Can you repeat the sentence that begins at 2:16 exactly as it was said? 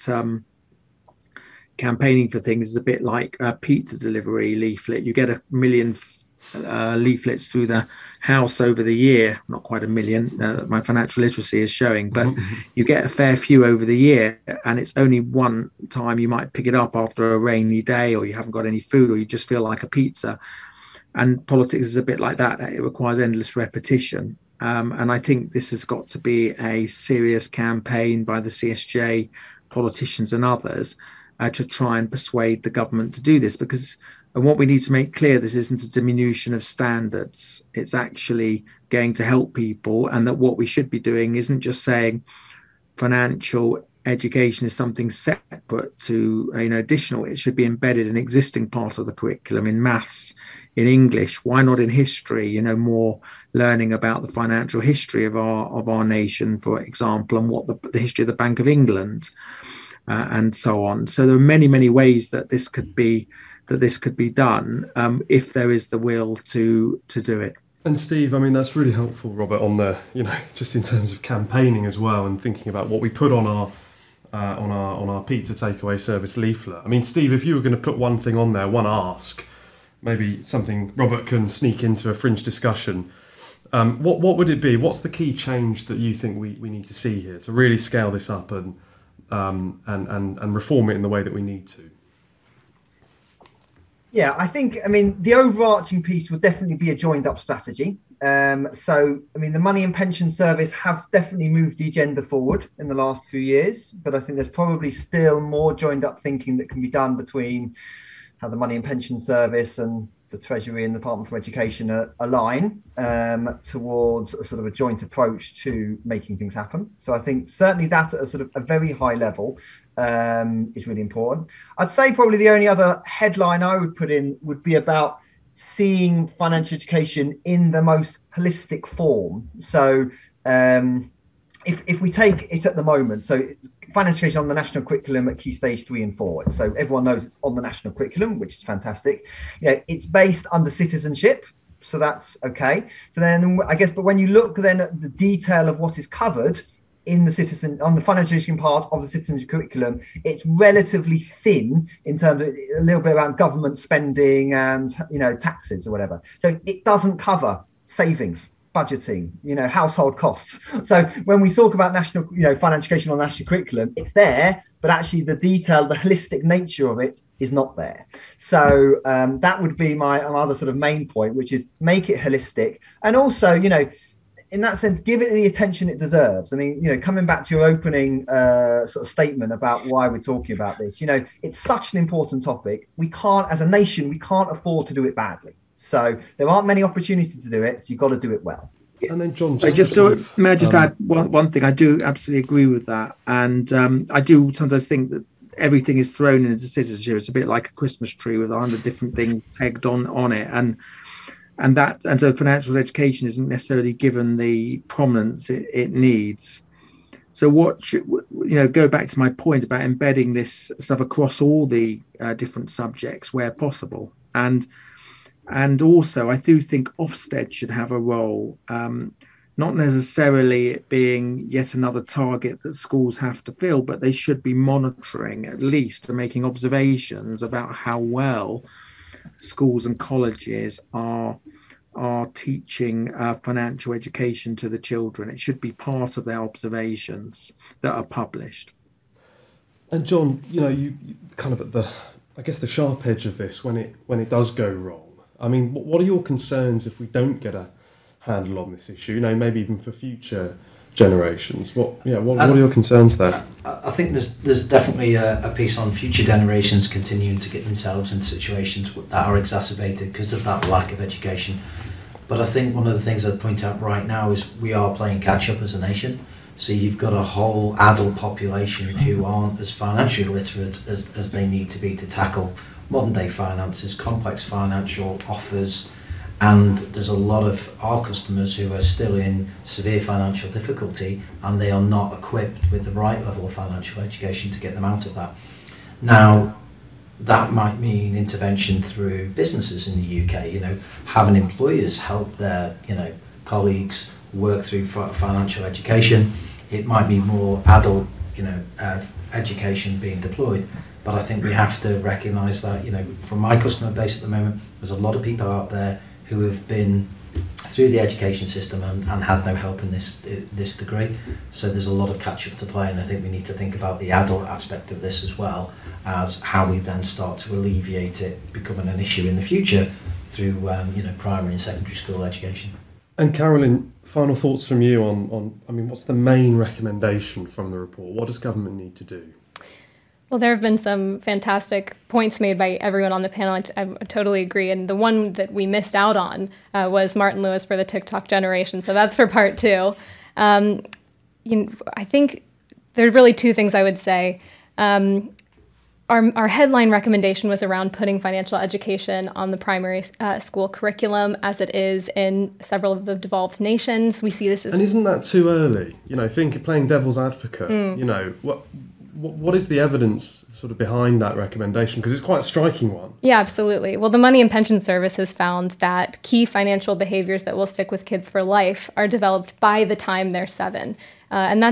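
So everyone knows it's on the national curriculum, which is fantastic.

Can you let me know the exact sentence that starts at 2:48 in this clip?
So um, that would be my other sort of main point, which is make it holistic.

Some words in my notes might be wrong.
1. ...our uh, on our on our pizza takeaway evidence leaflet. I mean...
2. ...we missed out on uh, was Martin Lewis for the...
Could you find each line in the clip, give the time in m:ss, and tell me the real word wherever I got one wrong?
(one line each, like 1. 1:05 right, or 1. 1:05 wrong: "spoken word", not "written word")
1. 1:13 wrong: "service", not "evidence"
2. 5:35 right.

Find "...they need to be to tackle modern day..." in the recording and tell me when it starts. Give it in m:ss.
4:31.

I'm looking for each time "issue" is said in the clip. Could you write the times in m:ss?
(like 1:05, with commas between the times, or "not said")
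4:08, 5:18.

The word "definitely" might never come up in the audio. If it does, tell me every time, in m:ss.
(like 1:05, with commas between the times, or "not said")
1:36, 1:41, 4:14.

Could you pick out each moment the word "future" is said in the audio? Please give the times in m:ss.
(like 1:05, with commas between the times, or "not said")
4:09, 4:15, 5:19.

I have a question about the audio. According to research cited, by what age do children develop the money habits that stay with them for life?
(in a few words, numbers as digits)
7.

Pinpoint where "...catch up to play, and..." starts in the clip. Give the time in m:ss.
5:12.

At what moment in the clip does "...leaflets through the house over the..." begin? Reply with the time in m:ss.
0:06.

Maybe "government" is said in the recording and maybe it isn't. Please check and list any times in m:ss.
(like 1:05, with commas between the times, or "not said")
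0:32, 2:33, 5:28.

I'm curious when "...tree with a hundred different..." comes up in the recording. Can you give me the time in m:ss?
3:18.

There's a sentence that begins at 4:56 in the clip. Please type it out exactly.
It might be more adult, you know, uh, education being deployed.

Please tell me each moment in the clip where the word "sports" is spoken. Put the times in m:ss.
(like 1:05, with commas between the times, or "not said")
not said.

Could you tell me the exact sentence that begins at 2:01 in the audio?
I'd say probably the only other headline I would put in would be about seeing financial education in the most holistic form.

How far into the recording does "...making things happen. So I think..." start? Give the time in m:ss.
1:56.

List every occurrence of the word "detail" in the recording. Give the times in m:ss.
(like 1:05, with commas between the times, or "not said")
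2:25, 2:45.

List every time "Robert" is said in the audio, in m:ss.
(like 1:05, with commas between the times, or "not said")
1:09, 1:20.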